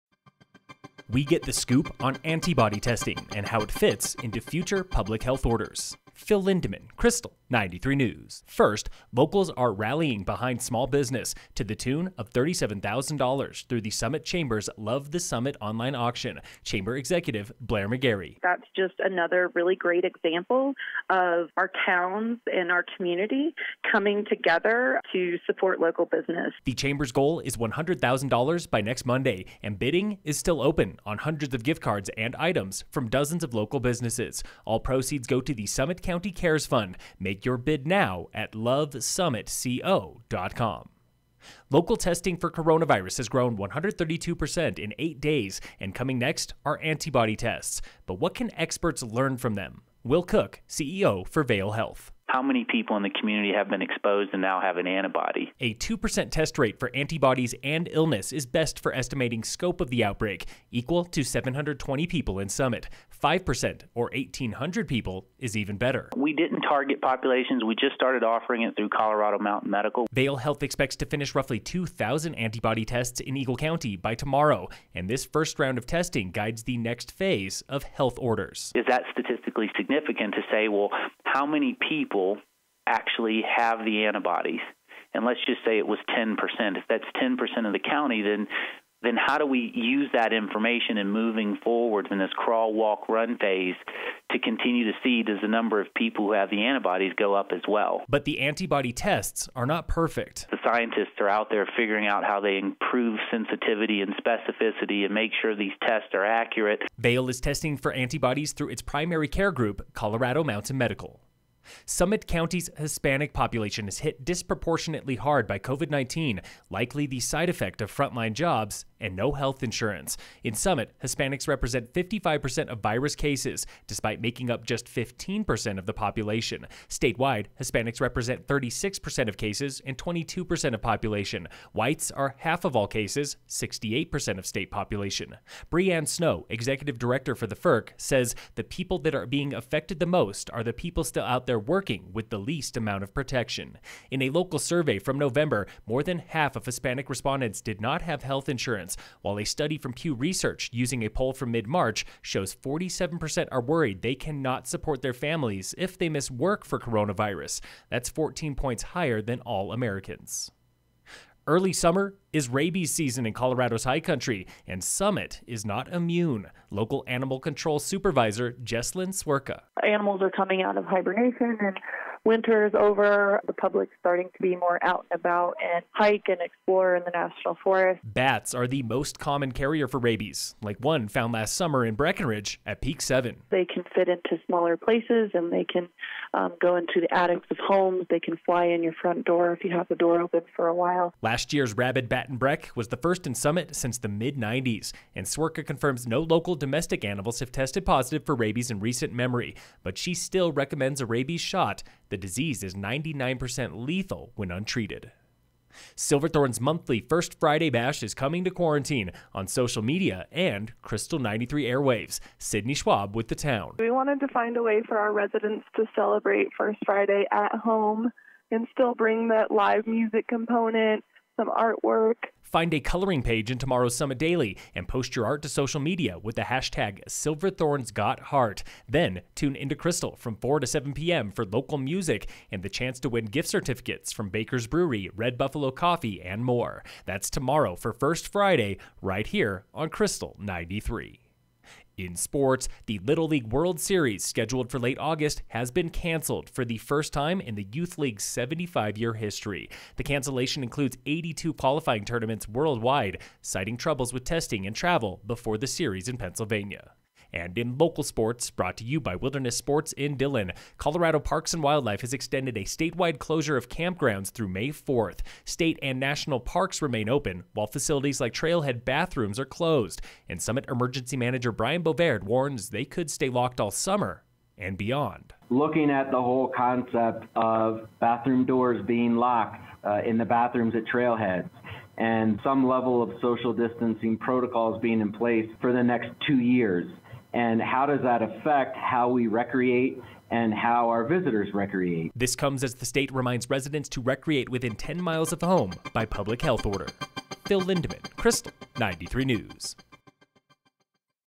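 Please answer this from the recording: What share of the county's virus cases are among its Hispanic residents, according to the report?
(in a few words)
55%.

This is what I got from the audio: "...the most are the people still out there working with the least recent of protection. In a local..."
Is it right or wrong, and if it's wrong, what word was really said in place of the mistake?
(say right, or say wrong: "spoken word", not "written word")
wrong: "amount", not "recent".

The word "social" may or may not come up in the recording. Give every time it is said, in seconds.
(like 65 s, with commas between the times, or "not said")
209 s, 225 s, 283 s.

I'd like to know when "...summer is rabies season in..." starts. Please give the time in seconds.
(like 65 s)
161 s.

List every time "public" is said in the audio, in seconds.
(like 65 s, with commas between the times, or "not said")
4 s, 173 s, 296 s.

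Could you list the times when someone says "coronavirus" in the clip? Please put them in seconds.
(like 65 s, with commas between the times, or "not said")
42 s, 156 s.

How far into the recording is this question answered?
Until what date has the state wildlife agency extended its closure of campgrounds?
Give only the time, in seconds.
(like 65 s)
264 s.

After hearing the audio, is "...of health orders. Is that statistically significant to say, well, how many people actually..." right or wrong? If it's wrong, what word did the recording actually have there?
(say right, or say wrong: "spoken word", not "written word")
right.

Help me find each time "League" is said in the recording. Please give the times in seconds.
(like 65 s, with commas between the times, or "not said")
243 s, 247 s.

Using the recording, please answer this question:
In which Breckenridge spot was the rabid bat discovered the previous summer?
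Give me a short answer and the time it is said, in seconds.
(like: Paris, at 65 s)
Peak seven, at 182 s.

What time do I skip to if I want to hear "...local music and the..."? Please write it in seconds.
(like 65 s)
231 s.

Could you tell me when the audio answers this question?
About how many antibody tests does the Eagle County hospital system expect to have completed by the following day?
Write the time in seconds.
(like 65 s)
71 s.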